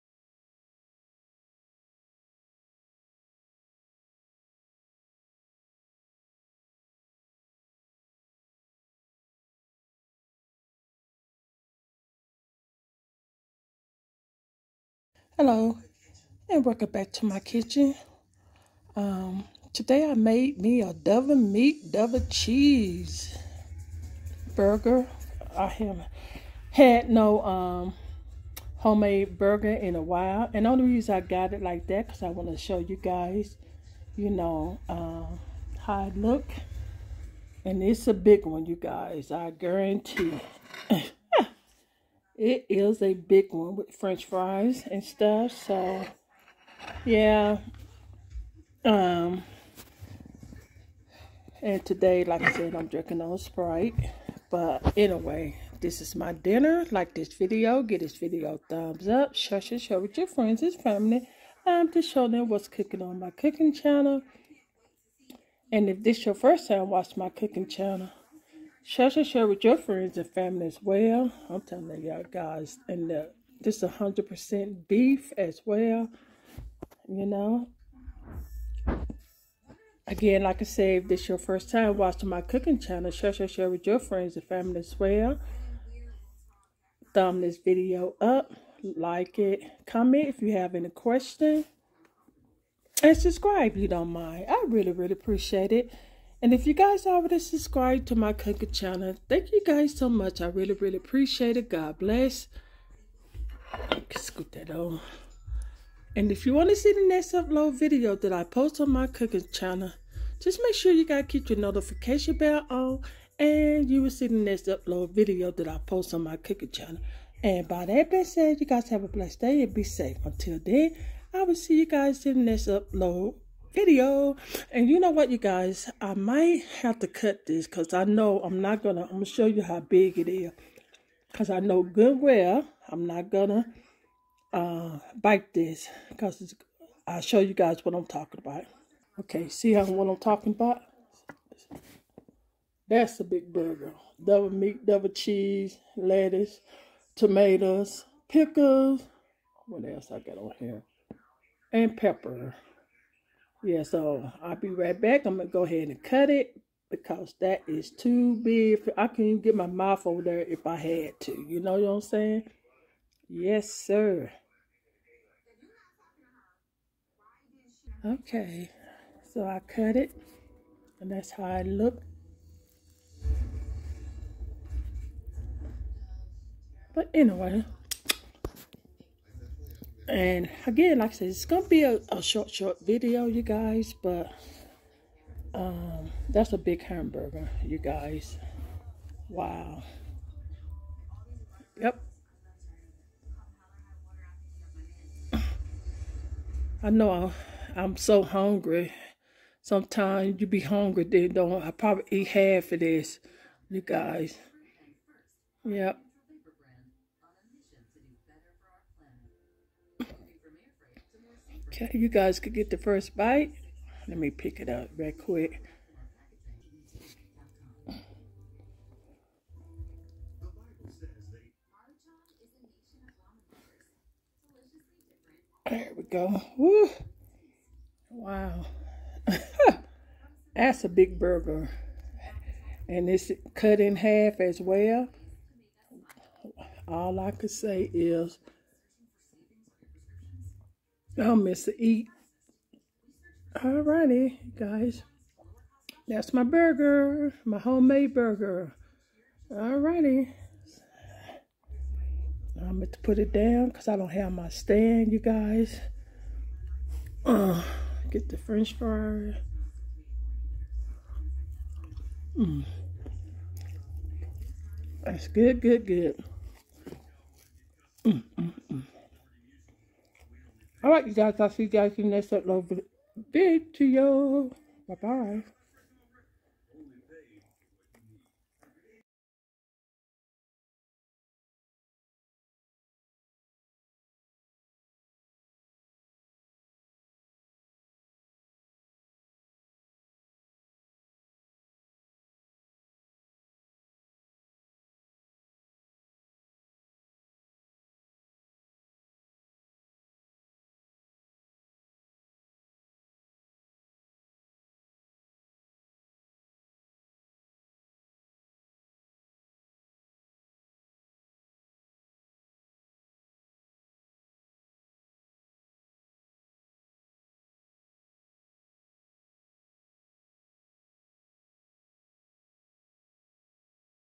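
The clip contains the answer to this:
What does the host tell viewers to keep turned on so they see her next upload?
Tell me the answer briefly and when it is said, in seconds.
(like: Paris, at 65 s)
notification bell, at 111 s.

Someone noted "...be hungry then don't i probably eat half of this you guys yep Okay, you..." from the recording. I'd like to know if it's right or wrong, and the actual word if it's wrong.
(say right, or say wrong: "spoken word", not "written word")
right.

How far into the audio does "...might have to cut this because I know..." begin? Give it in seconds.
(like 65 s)
126 s.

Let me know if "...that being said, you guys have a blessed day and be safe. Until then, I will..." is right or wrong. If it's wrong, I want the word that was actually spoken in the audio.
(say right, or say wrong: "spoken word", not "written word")
right.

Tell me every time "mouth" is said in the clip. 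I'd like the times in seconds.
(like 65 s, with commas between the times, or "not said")
159 s.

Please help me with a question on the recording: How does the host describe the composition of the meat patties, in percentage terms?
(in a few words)
100% beef.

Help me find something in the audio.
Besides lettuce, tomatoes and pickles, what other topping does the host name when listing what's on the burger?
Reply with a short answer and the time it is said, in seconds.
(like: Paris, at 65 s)
pepper, at 151 s.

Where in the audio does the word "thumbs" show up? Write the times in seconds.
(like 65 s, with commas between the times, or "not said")
58 s, 87 s.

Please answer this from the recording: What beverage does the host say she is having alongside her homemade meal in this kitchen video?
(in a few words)
Sprite.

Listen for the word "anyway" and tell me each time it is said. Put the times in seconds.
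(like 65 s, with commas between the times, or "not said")
54 s, 177 s.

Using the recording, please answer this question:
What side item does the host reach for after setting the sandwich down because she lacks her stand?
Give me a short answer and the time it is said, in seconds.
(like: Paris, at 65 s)
french fry, at 258 s.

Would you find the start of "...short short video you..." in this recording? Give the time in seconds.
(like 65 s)
182 s.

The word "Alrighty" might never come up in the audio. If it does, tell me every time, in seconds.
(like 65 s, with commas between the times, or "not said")
243 s, 249 s.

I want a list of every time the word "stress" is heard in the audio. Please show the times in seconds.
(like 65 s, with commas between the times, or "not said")
not said.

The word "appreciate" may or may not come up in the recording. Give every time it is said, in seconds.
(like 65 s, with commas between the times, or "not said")
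95 s, 100 s.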